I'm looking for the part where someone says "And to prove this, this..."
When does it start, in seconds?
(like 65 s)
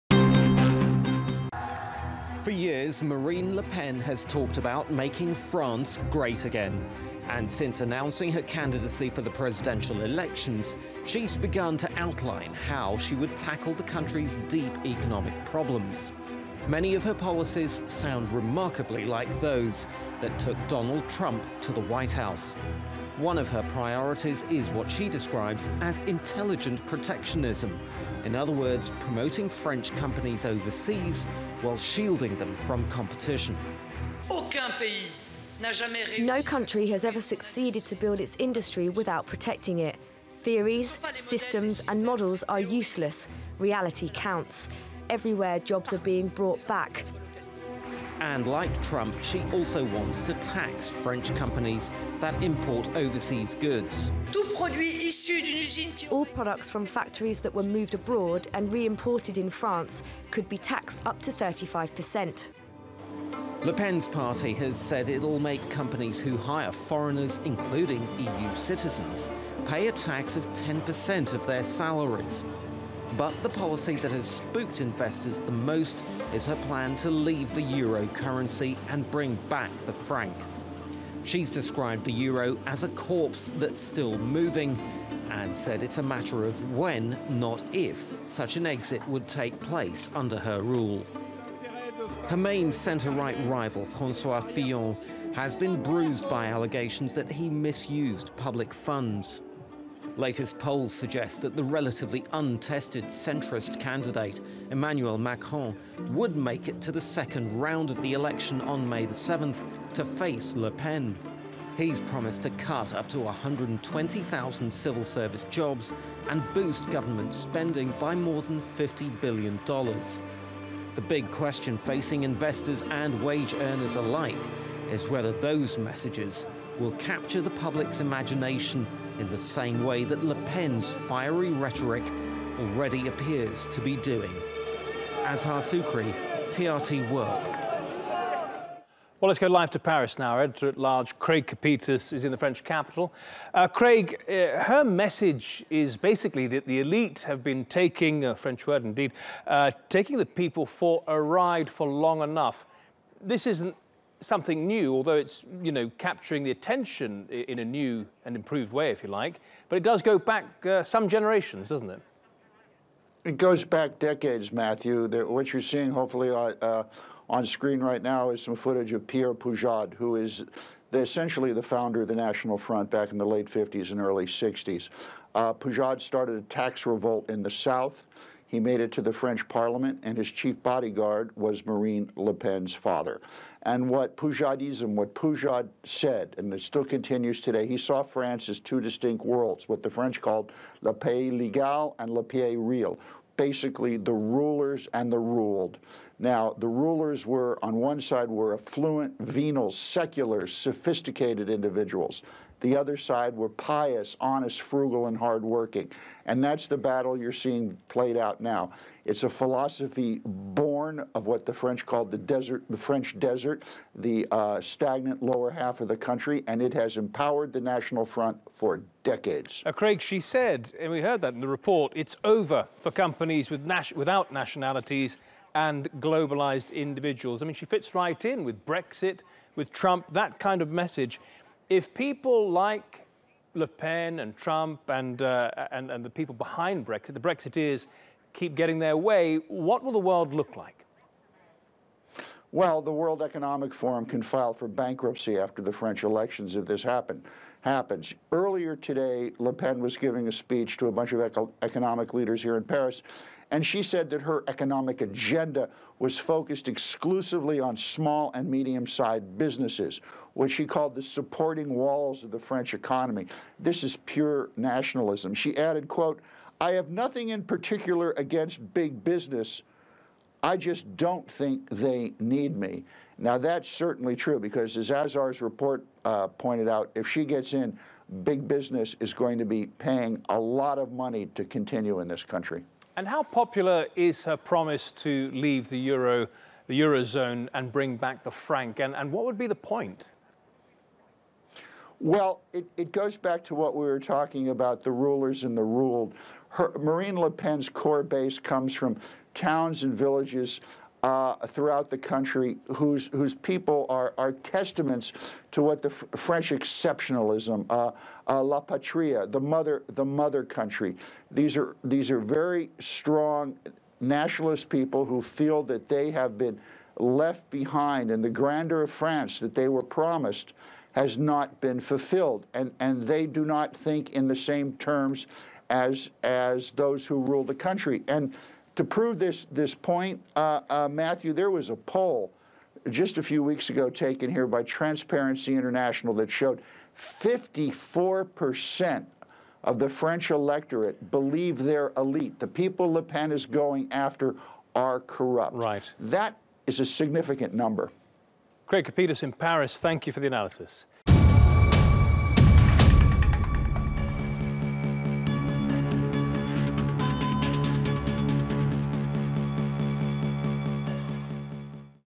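328 s.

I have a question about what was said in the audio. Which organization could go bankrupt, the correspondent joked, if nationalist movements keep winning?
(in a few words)
World Economic Forum.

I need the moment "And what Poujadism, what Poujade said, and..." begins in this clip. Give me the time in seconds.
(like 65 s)
183 s.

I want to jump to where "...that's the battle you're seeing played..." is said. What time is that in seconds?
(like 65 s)
206 s.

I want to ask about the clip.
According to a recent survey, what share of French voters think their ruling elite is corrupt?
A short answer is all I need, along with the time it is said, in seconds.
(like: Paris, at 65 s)
54%, at 336 s.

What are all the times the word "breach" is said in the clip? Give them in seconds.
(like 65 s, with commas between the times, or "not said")
not said.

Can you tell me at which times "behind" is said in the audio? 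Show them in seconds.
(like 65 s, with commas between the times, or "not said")
236 s, 317 s.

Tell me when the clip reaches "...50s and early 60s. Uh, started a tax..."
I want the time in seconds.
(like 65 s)
173 s.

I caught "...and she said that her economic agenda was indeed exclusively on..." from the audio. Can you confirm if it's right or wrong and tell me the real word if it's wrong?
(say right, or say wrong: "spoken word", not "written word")
wrong: "focused", not "indeed".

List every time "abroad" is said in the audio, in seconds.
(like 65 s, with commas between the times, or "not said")
57 s.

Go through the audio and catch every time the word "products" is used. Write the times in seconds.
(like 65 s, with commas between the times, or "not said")
56 s.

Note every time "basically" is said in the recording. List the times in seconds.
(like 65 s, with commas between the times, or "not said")
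145 s, 193 s.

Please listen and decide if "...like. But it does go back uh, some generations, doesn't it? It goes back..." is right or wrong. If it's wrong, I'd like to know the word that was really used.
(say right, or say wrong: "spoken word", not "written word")
right.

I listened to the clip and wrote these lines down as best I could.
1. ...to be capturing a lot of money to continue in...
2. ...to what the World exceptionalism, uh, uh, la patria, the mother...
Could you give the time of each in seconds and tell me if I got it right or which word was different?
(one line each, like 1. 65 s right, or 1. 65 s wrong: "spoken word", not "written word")
1. 279 s wrong: "paying", not "capturing"
2. 305 s wrong: "French", not "World".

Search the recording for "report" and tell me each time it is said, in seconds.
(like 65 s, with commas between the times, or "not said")
221 s, 275 s.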